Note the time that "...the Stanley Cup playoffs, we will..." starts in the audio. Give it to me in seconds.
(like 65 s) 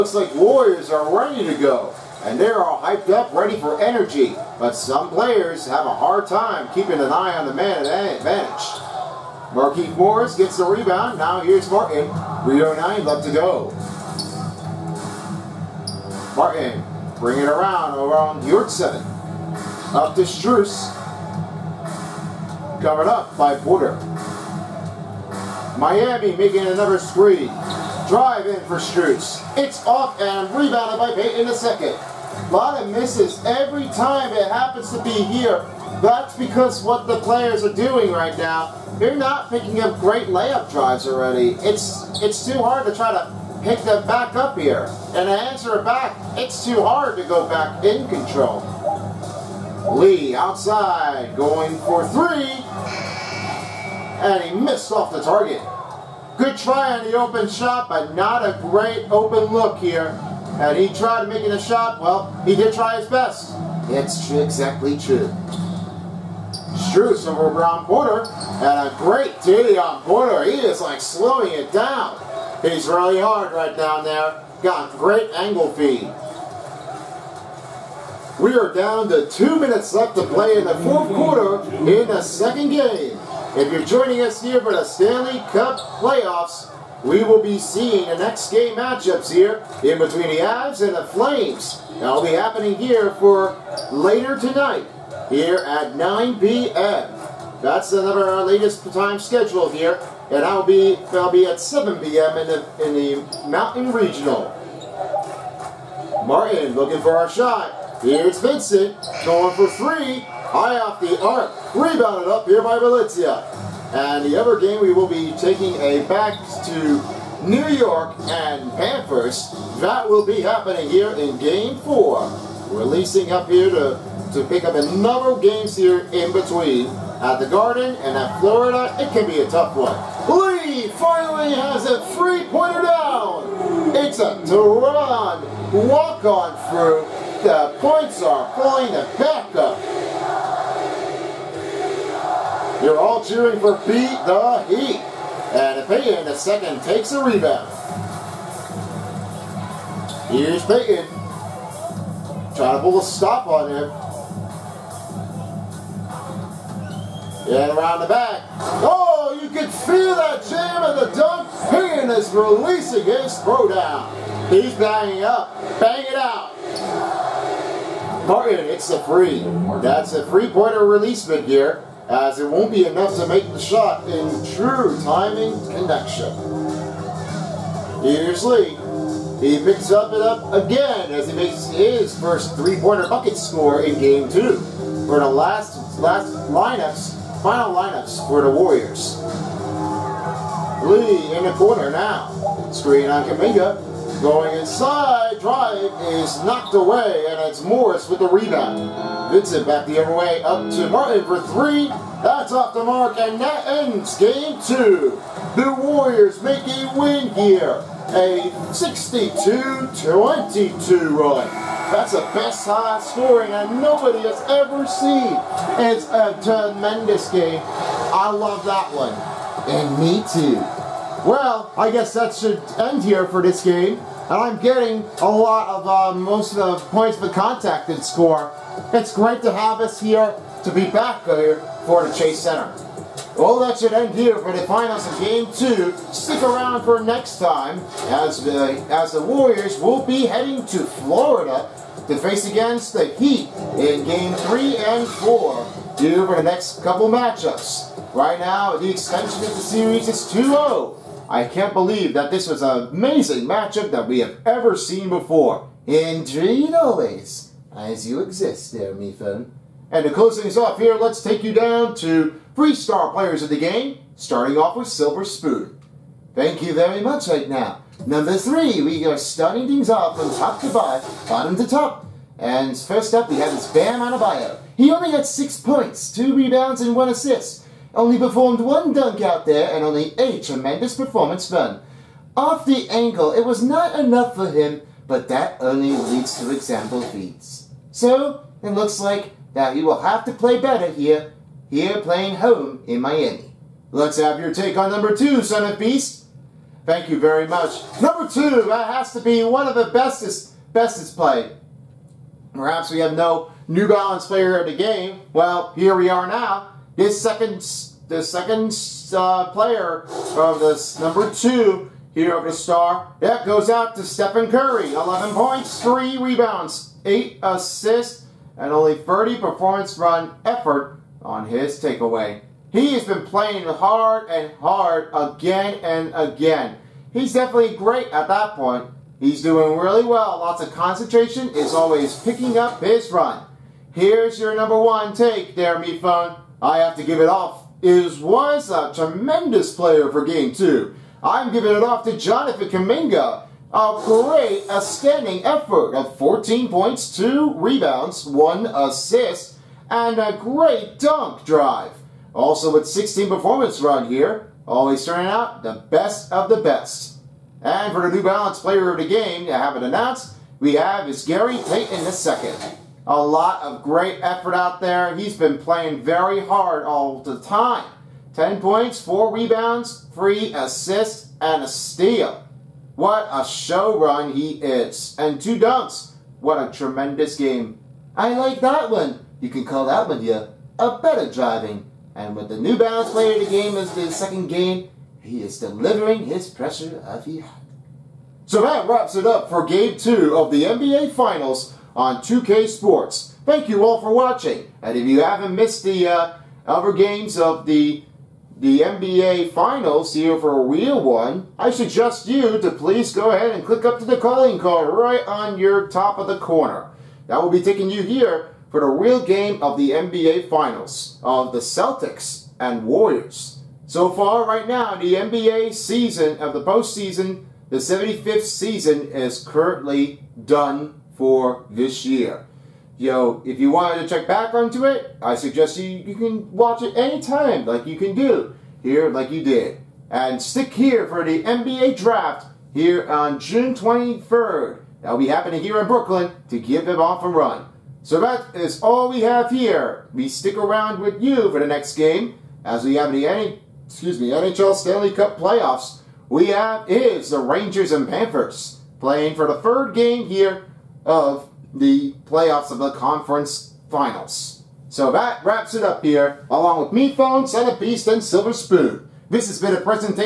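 84 s.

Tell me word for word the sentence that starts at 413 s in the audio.
So far, right now, the NBA season of the postseason, the 75th season, is currently done for this year.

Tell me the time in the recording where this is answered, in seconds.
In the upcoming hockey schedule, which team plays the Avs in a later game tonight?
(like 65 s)
90 s.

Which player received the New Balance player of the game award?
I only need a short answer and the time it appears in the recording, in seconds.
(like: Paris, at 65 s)
Gary Payton II, at 361 s.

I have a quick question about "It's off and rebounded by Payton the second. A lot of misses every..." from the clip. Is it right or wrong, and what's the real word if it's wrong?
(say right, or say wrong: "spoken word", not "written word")
right.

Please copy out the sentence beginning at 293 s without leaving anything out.
Let's have your take on number two, Son of Beast.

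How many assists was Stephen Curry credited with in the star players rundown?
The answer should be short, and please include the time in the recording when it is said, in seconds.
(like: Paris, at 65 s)
8, at 317 s.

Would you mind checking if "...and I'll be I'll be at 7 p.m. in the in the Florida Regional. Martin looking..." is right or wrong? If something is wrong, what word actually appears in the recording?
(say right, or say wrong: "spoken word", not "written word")
wrong: "Mountain", not "Florida".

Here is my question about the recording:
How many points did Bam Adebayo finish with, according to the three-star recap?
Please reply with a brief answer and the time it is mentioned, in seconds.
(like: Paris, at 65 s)
6, at 275 s.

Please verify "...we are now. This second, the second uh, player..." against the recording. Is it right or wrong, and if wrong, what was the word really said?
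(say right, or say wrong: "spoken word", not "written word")
right.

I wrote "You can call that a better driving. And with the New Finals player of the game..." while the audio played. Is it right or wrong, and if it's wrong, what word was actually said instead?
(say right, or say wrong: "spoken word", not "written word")
wrong: "Balance", not "Finals".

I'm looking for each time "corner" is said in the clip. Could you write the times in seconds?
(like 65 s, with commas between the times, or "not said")
191 s, 406 s.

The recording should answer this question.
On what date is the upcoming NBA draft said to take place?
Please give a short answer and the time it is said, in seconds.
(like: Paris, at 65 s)
June 23, at 433 s.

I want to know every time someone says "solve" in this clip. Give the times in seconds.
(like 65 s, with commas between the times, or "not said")
not said.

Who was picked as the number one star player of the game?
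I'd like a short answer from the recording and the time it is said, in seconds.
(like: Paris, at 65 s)
Jonathan Kuminga, at 342 s.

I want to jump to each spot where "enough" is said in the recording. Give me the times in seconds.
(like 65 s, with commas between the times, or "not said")
172 s, 283 s.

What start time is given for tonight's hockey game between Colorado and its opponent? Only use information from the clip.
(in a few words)
9 p.m.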